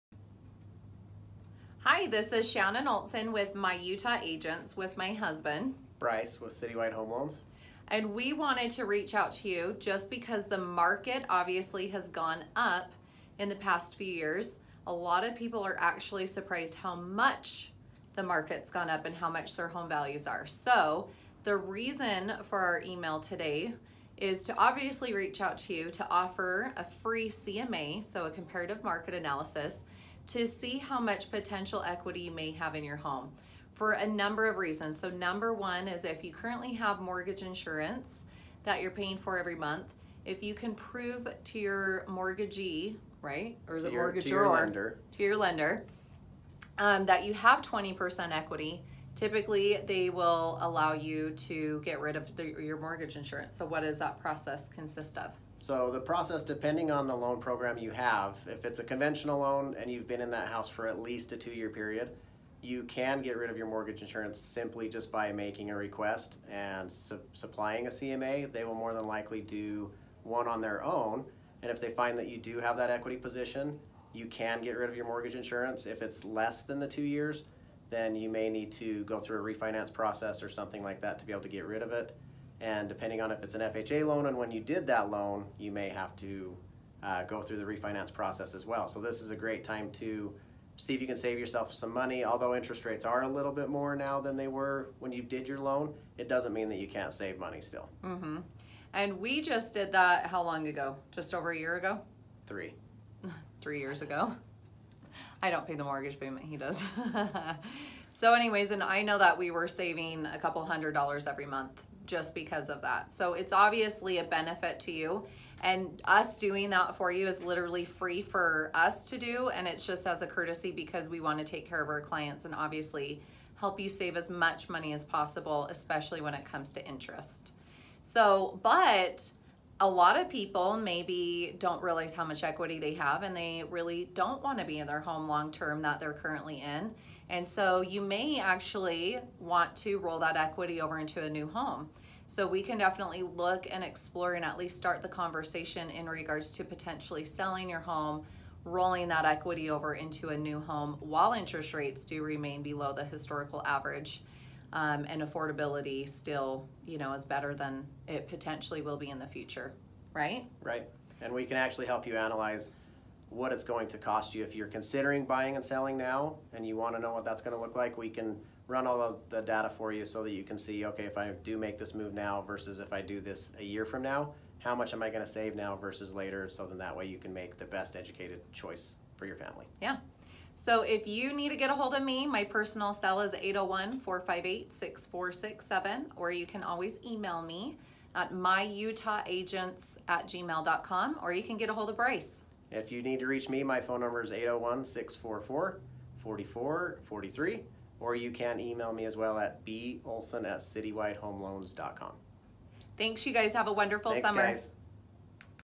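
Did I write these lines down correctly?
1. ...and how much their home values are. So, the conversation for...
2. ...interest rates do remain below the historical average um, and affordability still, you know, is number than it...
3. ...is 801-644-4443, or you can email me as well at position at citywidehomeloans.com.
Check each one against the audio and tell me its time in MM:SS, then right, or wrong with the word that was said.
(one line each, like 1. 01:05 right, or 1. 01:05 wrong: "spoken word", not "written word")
1. 00:19 wrong: "reason", not "conversation"
2. 02:31 wrong: "better", not "number"
3. 03:14 wrong: "bolson", not "position".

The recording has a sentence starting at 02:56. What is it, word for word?
So then that way you can make the best educated choice for your family.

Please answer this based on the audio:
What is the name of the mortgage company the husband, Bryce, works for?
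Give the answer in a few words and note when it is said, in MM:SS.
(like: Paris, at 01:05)
Citywide Home Loans, at 00:06.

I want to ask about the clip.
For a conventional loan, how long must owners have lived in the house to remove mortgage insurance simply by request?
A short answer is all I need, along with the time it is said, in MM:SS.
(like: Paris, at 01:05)
two year period, at 01:01.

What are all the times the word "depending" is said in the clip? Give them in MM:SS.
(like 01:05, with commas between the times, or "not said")
00:56, 01:22.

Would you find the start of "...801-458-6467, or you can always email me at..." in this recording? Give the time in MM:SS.
03:03.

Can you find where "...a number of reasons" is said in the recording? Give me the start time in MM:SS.
00:33.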